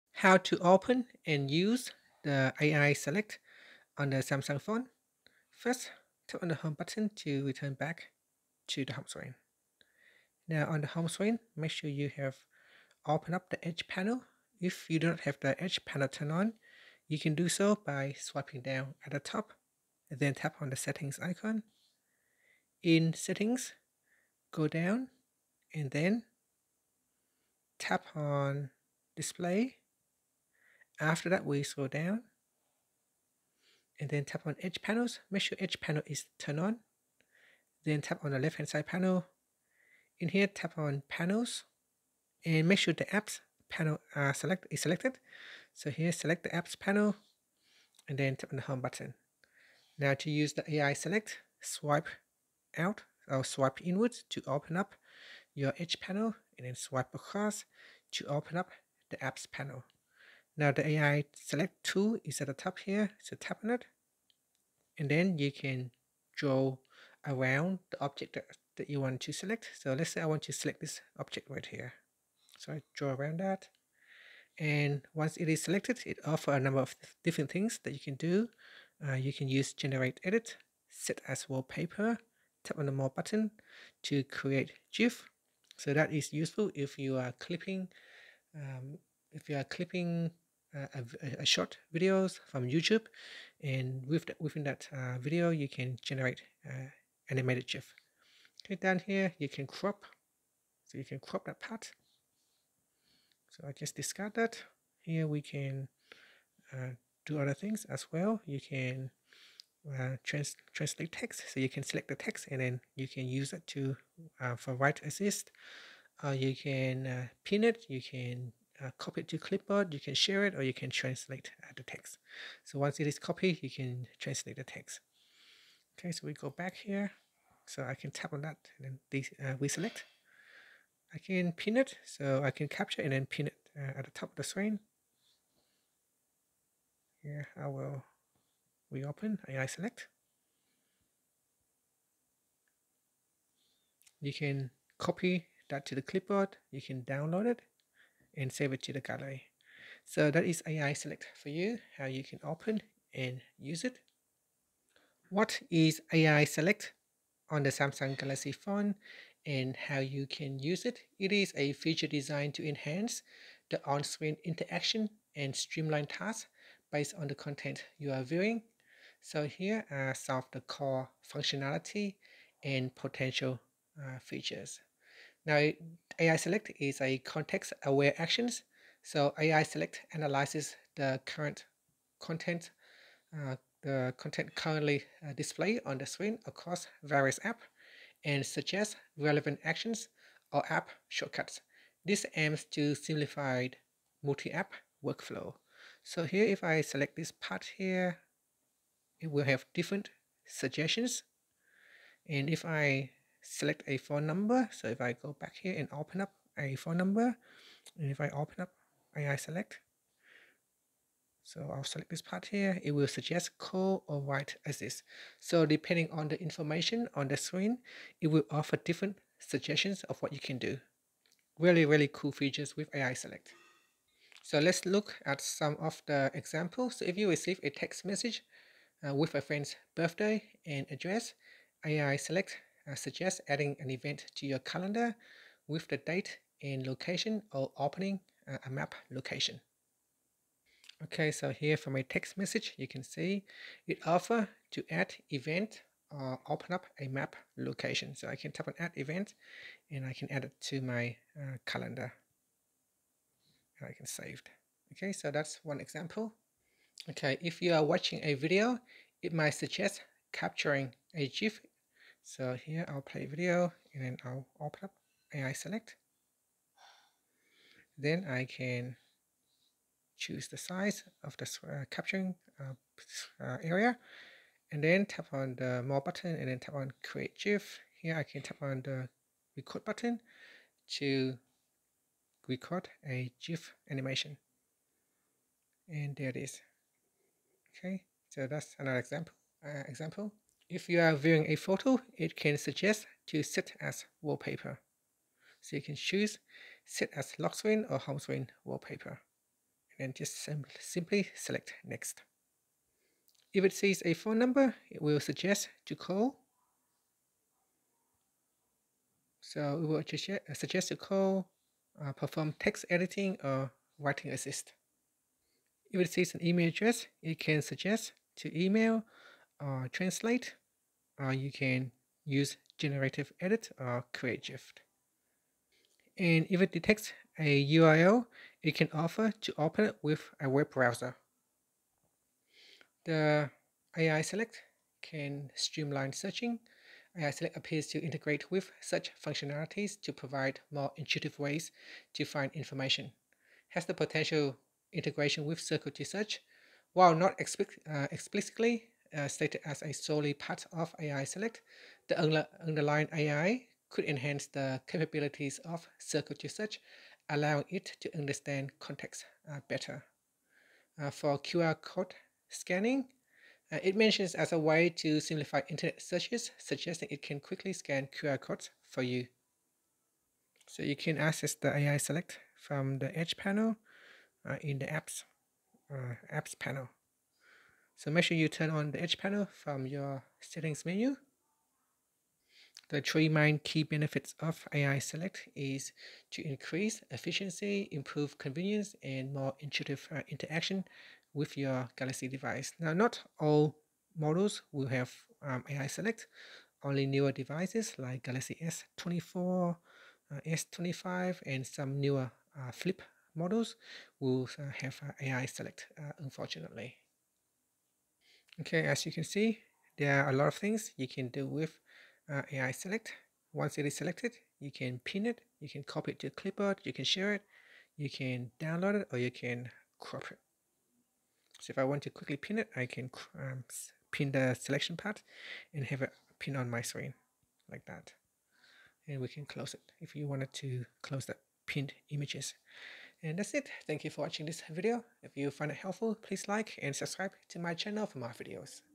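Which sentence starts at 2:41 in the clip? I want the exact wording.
It is a feature designed to enhance the on-screen interaction and streamline tasks based on the content you are viewing.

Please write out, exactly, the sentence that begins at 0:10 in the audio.
Now on the home screen, make sure you have opened up the Edge panel.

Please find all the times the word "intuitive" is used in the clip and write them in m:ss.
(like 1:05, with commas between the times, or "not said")
5:40, 6:29.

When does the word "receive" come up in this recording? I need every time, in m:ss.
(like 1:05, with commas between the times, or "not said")
3:47.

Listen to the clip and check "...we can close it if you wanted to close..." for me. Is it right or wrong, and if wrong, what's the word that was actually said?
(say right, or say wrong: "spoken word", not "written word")
right.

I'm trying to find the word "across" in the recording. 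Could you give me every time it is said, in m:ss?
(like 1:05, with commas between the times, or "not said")
0:57, 3:06.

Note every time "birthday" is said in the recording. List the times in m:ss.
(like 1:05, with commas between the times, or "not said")
3:49.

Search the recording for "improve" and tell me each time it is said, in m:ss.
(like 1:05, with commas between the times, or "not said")
6:27.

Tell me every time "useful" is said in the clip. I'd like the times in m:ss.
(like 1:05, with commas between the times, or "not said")
1:26.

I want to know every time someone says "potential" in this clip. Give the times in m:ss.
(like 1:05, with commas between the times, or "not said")
2:52, 5:43.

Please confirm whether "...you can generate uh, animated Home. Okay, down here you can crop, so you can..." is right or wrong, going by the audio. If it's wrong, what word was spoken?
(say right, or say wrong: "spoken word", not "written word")
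wrong: "GIF", not "Home".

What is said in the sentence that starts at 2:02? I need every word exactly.
So once it is copied, you can translate the text.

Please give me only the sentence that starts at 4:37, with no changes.
Here I can tap on the record button to record a GIF animation.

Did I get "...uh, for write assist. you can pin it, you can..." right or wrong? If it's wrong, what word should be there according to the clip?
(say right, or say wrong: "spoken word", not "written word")
right.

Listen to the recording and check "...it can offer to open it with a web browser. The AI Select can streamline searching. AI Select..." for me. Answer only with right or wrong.
right.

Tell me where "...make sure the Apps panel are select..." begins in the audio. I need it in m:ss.
0:42.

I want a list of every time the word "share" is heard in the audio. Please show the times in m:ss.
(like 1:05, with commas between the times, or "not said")
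2:00, 6:57.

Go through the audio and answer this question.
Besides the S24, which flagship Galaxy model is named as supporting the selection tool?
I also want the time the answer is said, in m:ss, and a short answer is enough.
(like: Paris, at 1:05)
Galaxy S25, at 6:40.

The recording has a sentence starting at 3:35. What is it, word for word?
So depending on the information on the screen, it will offer different suggestions of what you can do.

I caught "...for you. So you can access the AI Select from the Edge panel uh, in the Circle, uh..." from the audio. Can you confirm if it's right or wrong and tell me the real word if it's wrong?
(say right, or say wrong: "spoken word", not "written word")
wrong: "Apps", not "Circle".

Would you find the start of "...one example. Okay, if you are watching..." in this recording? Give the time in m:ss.
4:15.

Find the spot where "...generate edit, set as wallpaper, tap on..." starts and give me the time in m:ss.
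1:19.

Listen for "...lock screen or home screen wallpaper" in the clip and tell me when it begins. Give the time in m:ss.
4:57.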